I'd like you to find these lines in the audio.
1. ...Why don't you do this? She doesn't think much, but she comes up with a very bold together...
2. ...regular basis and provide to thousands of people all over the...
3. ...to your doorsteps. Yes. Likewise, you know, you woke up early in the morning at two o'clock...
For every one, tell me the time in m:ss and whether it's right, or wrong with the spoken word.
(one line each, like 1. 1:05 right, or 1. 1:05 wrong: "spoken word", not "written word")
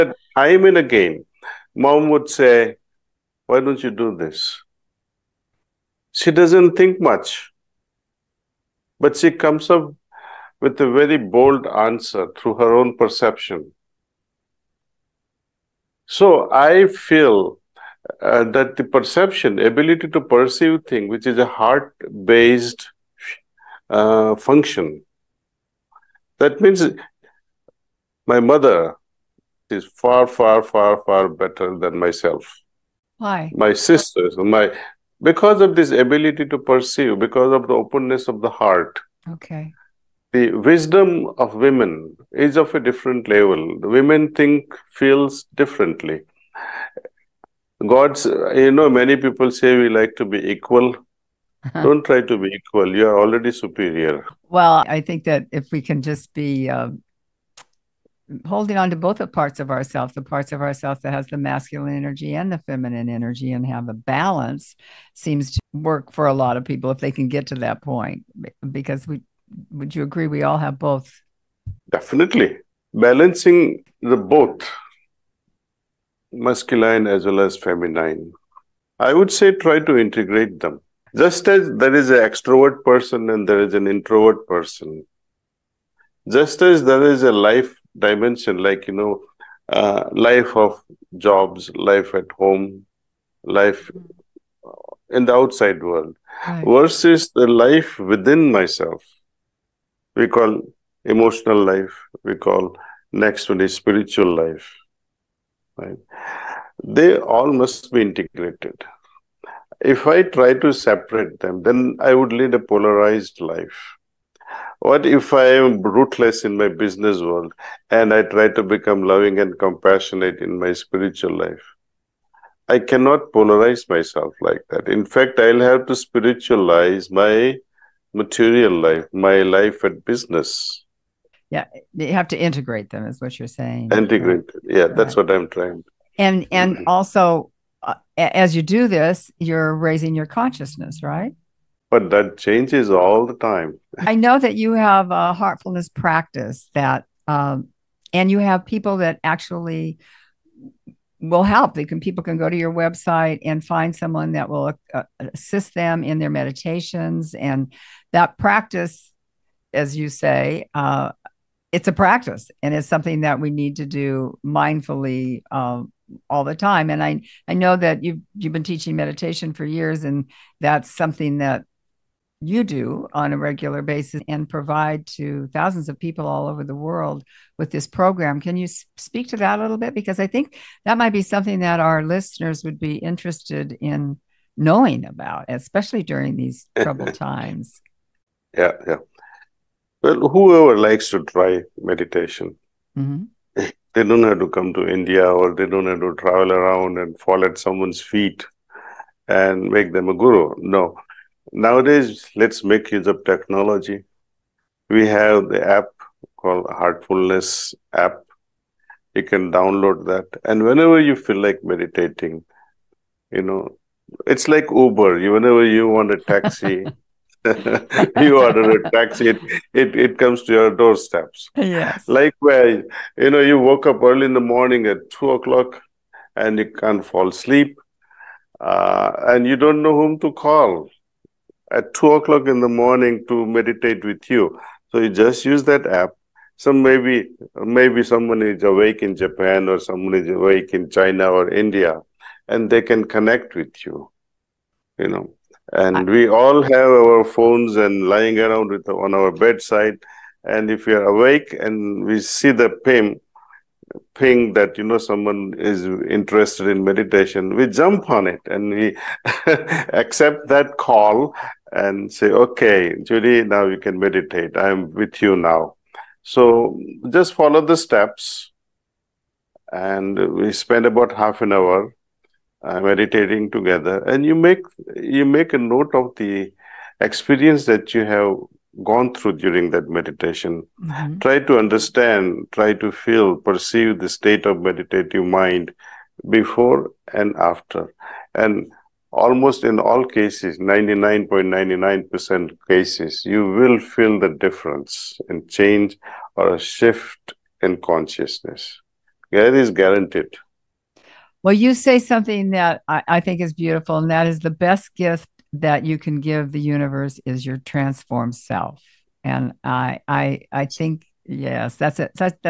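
1. 0:03 wrong: "answer", not "together"
2. 2:53 right
3. 3:40 right.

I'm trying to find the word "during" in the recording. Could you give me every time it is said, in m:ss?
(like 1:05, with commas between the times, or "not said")
3:06, 4:39.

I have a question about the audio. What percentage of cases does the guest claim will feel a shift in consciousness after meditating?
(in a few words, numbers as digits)
99.99%.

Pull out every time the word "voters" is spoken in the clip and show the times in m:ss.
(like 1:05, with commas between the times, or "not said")
not said.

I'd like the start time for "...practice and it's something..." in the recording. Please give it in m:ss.
2:41.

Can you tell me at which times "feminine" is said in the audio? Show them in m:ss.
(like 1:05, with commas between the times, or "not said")
1:02, 1:17.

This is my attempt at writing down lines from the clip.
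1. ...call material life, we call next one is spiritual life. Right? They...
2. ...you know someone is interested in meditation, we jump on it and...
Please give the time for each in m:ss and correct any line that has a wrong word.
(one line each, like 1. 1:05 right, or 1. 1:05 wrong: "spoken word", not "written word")
1. 1:40 wrong: "emotional", not "material"
2. 4:14 right.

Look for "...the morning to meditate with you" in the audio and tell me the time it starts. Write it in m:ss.
3:52.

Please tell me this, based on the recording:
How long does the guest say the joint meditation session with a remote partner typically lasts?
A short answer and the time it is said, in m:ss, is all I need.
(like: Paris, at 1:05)
Half an hour, at 4:31.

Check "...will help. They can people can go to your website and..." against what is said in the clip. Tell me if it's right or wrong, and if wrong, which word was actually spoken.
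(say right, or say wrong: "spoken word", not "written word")
right.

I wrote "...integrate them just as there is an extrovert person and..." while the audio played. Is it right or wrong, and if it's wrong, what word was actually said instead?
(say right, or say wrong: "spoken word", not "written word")
right.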